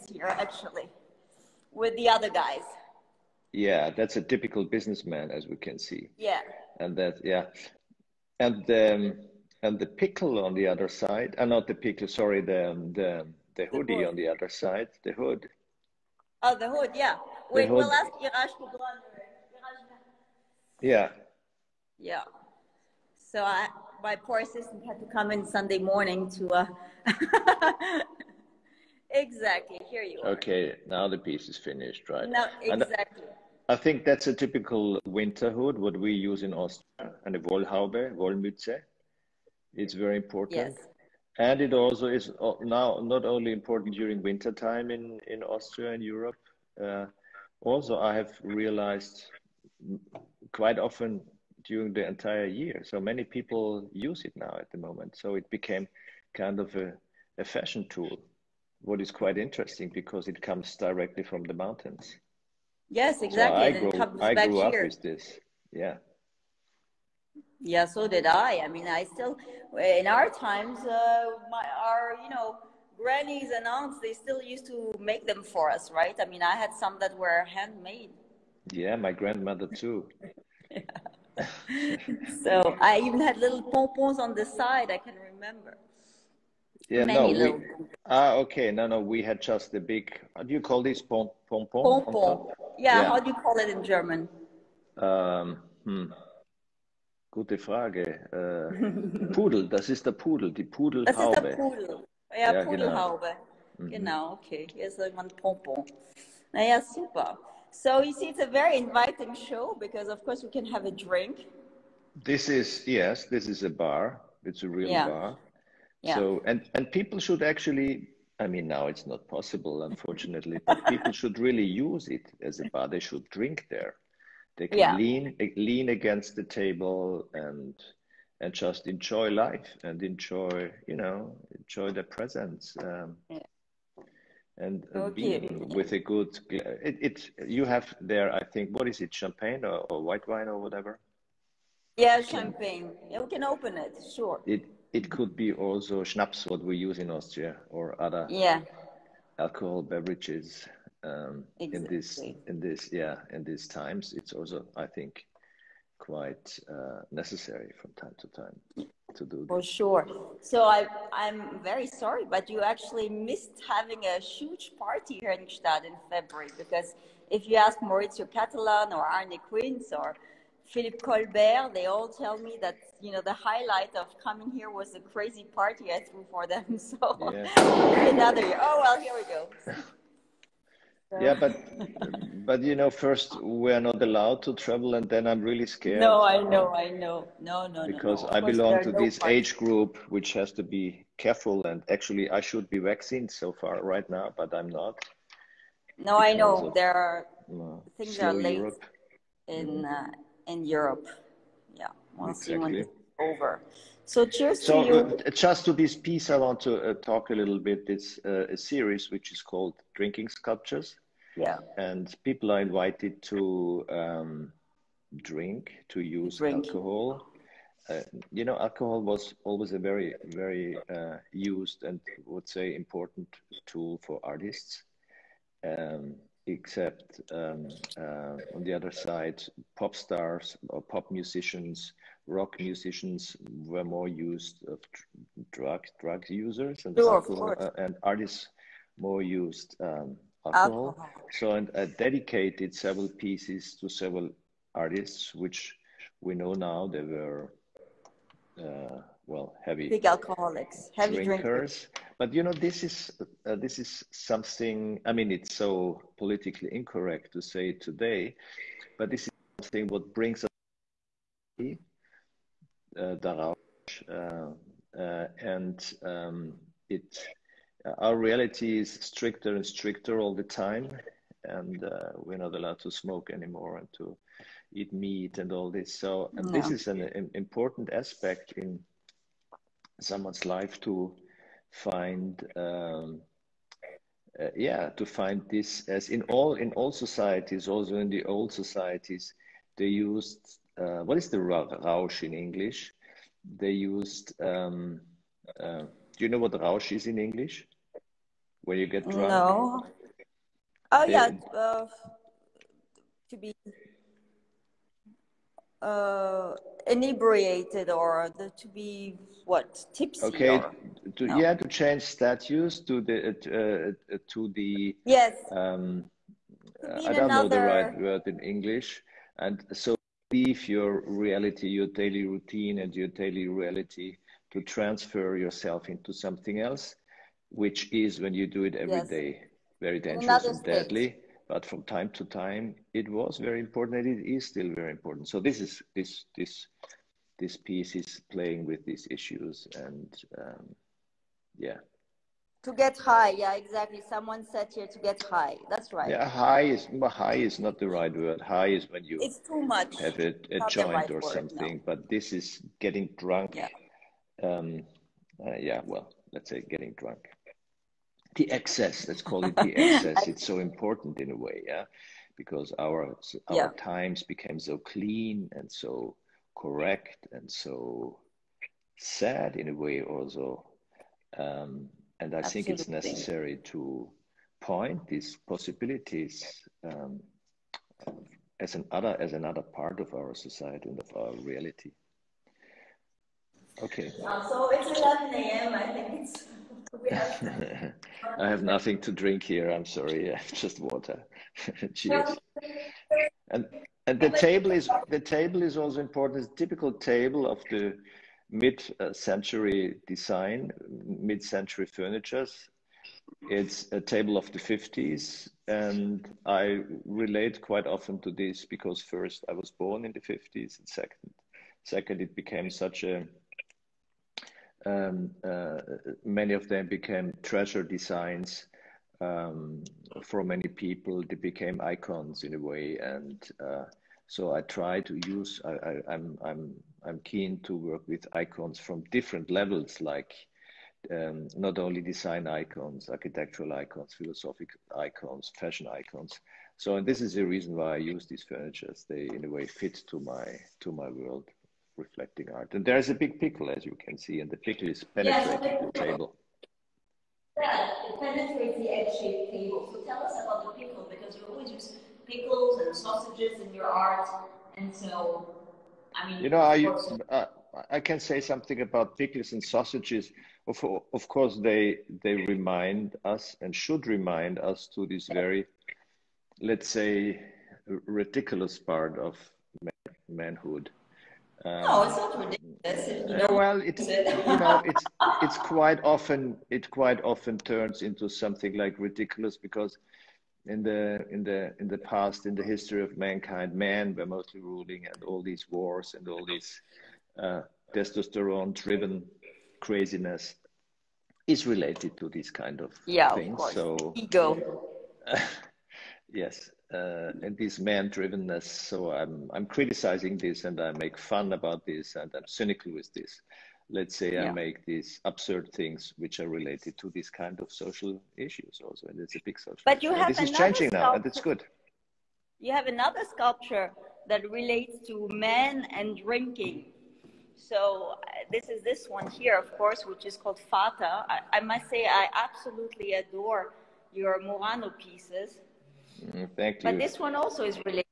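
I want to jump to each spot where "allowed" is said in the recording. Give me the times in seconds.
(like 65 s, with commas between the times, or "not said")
184 s, 272 s.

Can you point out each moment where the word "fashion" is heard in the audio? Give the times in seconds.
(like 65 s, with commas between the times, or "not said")
57 s, 435 s.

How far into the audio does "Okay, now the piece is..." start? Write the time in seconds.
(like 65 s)
30 s.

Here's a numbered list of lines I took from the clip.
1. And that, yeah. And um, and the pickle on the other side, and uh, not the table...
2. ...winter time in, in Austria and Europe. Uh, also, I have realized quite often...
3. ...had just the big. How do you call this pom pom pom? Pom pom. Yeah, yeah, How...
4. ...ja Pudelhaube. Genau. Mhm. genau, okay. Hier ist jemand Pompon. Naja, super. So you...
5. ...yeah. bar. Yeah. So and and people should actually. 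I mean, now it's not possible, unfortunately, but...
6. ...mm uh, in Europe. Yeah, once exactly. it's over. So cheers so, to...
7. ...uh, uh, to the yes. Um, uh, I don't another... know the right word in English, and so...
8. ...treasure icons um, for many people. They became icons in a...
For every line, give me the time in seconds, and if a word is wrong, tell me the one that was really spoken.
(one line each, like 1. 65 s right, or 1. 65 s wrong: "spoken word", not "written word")
1. 6 s wrong: "pickle", not "table"
2. 44 s right
3. 89 s right
4. 102 s right
5. 114 s right
6. 199 s right
7. 313 s right
8. 417 s wrong: "designs", not "icons".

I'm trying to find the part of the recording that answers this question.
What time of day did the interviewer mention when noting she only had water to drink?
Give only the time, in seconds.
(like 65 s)
384 s.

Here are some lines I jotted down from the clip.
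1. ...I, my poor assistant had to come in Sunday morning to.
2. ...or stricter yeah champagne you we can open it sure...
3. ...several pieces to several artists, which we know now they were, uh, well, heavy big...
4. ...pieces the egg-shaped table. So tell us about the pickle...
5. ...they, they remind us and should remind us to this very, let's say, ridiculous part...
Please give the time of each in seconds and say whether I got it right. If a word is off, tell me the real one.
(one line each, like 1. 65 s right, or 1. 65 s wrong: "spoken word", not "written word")
1. 23 s right
2. 140 s wrong: "whatever", not "stricter"
3. 242 s right
4. 448 s wrong: "penetrates", not "pieces"
5. 461 s right.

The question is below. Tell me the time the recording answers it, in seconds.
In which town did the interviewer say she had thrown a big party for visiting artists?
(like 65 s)
165 s.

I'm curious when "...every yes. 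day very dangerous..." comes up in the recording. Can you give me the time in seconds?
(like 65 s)
328 s.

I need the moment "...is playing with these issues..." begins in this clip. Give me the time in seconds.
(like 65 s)
337 s.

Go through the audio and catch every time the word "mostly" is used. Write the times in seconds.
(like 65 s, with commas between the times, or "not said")
484 s.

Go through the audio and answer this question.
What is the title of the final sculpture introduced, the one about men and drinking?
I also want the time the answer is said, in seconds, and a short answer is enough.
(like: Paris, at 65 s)
Vater, at 520 s.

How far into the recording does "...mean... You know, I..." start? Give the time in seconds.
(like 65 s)
456 s.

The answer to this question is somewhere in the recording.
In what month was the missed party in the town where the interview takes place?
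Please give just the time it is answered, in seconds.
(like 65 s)
166 s.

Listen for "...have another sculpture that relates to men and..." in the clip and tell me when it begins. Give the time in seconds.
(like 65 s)
512 s.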